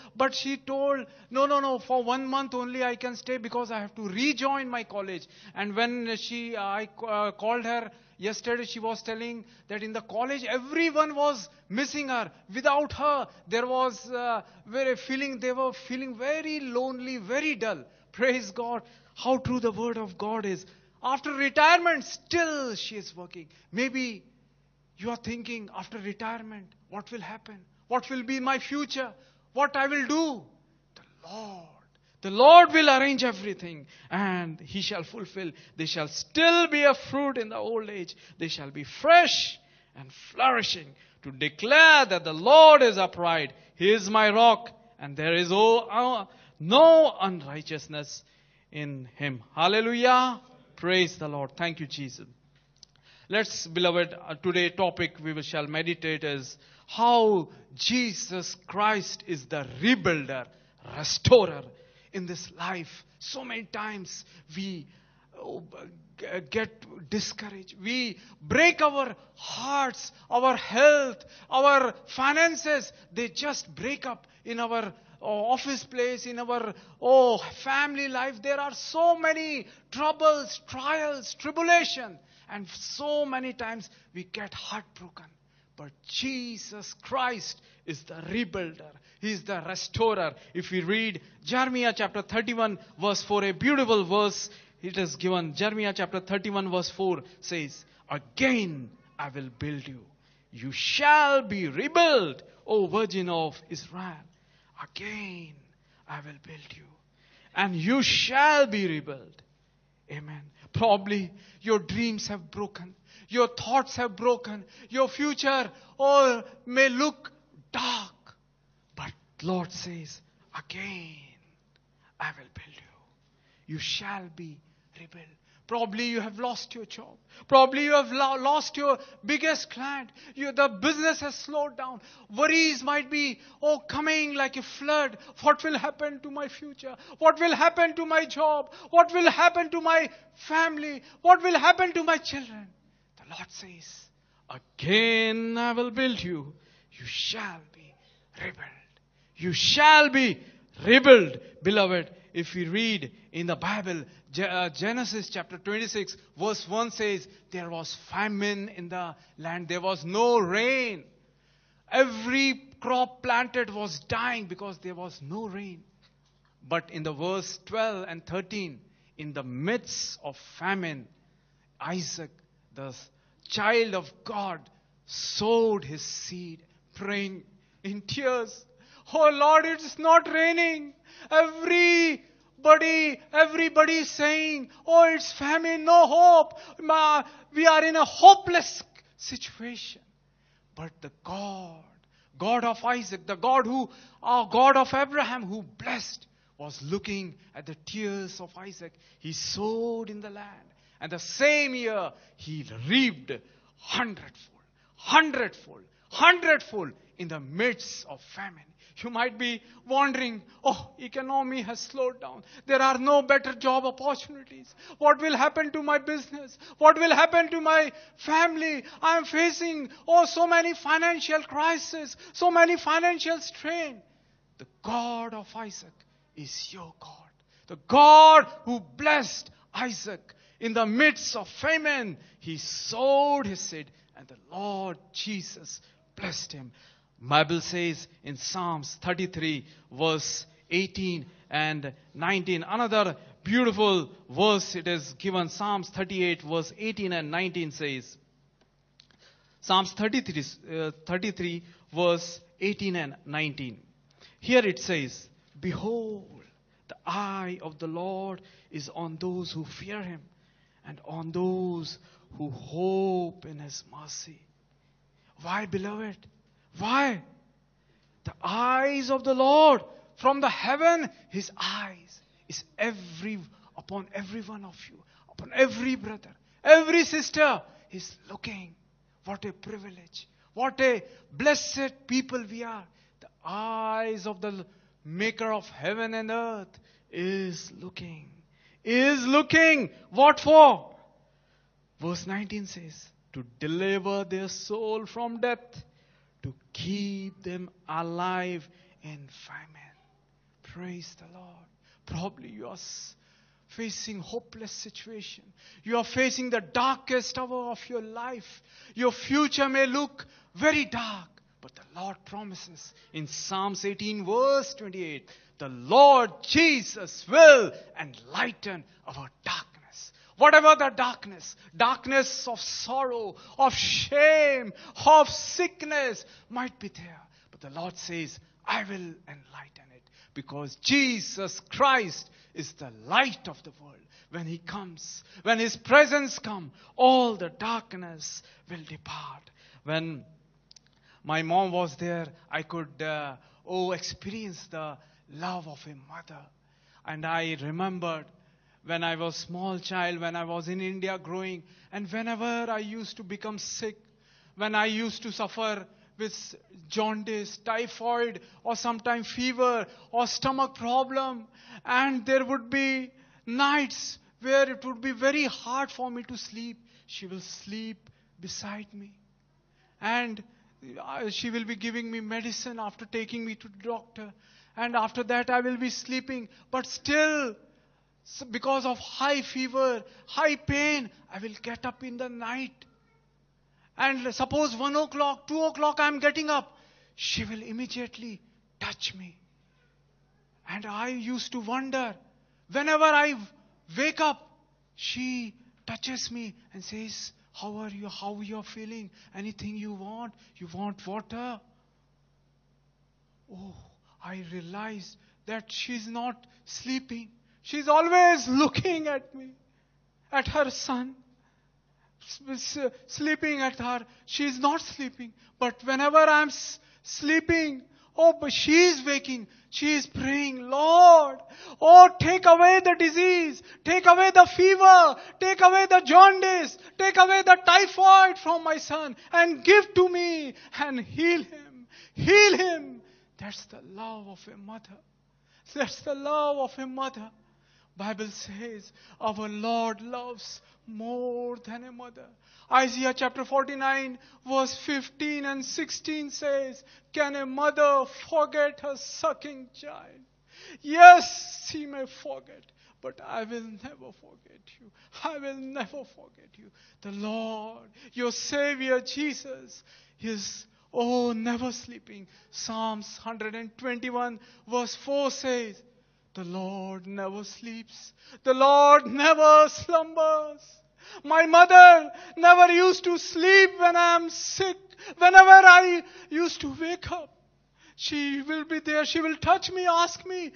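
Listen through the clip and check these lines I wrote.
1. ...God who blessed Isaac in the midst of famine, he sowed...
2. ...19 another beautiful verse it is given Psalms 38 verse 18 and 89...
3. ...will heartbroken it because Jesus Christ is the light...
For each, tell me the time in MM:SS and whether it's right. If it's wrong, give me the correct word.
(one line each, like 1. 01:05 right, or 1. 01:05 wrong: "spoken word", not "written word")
1. 03:47 right
2. 04:02 wrong: "19", not "89"
3. 05:28 wrong: "enlighten", not "heartbroken".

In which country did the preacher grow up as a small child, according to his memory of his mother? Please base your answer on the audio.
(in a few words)
India.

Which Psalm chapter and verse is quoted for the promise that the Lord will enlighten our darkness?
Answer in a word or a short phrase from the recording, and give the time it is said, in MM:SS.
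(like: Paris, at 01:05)
Psalms 18:28, at 05:13.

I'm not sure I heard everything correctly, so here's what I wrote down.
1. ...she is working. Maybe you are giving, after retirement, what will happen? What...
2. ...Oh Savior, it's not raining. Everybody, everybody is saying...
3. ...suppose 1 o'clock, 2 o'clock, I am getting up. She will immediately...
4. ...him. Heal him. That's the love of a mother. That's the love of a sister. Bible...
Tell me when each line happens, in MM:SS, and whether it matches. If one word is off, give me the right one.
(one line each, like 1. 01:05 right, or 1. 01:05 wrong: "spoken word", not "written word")
1. 00:22 wrong: "thinking", not "giving"
2. 02:59 wrong: "Lord", not "Savior"
3. 06:24 right
4. 07:11 wrong: "mother", not "sister".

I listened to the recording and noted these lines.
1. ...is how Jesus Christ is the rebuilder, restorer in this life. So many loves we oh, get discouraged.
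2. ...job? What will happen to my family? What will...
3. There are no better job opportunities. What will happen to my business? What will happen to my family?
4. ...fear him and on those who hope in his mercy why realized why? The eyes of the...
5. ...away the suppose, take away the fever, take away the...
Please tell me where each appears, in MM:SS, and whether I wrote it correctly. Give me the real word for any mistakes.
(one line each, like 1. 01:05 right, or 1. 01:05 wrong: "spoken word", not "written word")
1. 00:56 wrong: "times", not "loves"
2. 02:18 right
3. 03:32 right
4. 04:19 wrong: "beloved", not "realized"
5. 07:02 wrong: "disease", not "suppose".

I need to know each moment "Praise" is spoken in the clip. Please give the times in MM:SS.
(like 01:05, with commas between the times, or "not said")
00:18, 00:50, 05:00.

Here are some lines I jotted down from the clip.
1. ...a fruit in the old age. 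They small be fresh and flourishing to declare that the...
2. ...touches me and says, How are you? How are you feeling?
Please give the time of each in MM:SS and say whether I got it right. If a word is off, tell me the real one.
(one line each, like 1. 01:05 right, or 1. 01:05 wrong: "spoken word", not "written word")
1. 00:36 wrong: "shall", not "small"
2. 06:35 right.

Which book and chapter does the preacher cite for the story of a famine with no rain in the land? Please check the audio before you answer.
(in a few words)
Genesis 26.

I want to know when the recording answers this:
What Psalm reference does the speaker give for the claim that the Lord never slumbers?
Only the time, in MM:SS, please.
07:42.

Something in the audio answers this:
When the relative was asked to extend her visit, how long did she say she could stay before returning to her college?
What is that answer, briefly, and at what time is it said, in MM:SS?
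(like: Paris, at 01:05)
one month, at 00:02.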